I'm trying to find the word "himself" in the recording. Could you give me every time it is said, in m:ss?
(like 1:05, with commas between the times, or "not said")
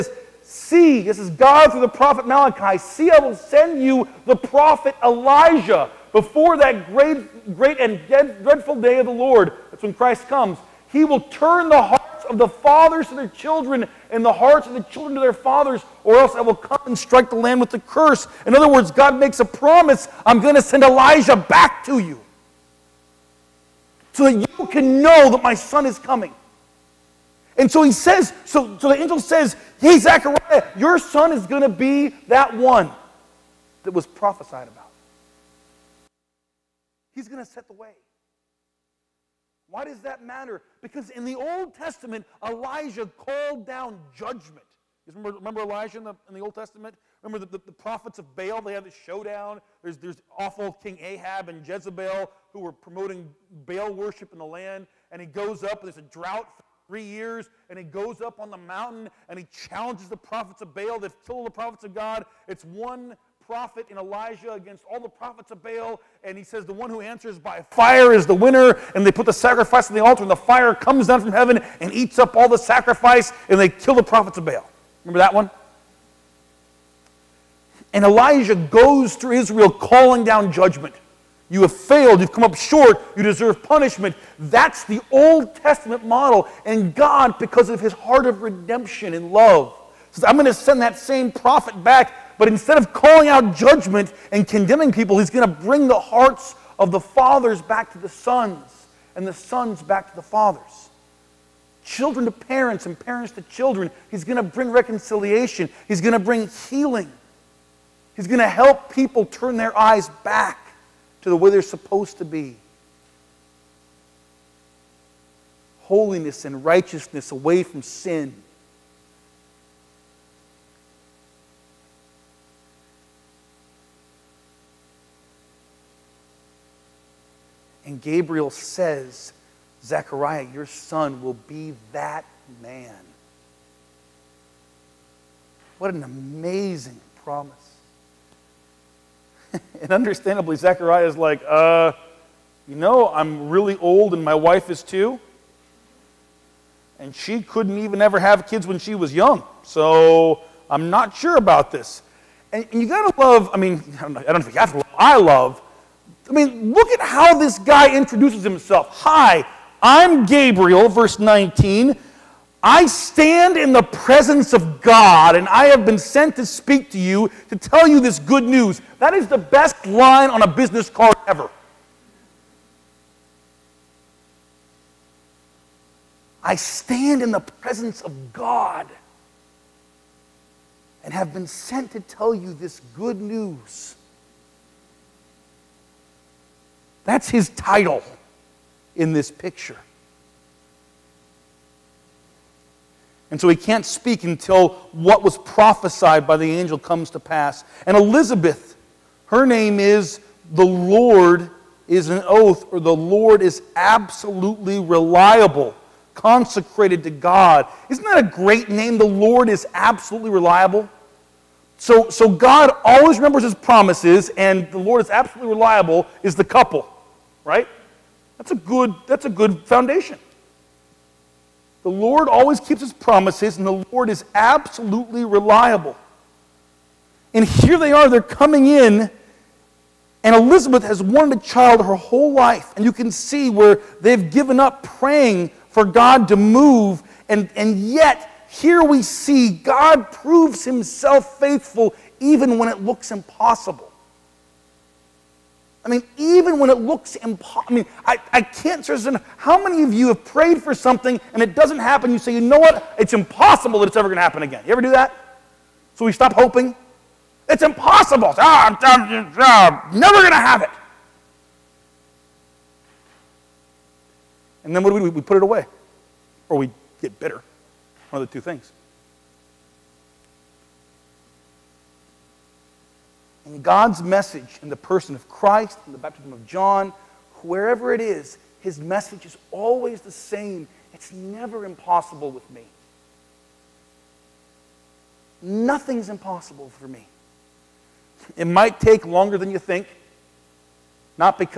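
2:38, 4:00.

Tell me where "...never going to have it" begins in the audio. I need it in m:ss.
4:19.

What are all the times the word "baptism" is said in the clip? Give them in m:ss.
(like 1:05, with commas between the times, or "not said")
4:35.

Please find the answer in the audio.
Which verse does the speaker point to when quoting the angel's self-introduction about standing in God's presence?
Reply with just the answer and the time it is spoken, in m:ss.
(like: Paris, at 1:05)
Verse 19, at 2:40.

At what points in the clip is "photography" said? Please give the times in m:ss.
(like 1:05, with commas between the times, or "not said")
not said.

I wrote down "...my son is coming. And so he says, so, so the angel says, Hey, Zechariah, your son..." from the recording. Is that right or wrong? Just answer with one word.
right.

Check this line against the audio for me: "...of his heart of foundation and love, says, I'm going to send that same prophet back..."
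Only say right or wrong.
wrong.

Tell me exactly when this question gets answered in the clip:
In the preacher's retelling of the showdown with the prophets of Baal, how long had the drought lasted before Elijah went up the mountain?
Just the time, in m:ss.
0:56.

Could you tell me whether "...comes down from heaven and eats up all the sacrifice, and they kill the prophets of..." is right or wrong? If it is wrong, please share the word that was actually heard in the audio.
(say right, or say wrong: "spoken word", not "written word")
right.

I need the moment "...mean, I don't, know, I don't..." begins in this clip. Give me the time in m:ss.
2:33.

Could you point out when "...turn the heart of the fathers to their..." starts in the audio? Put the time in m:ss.
0:11.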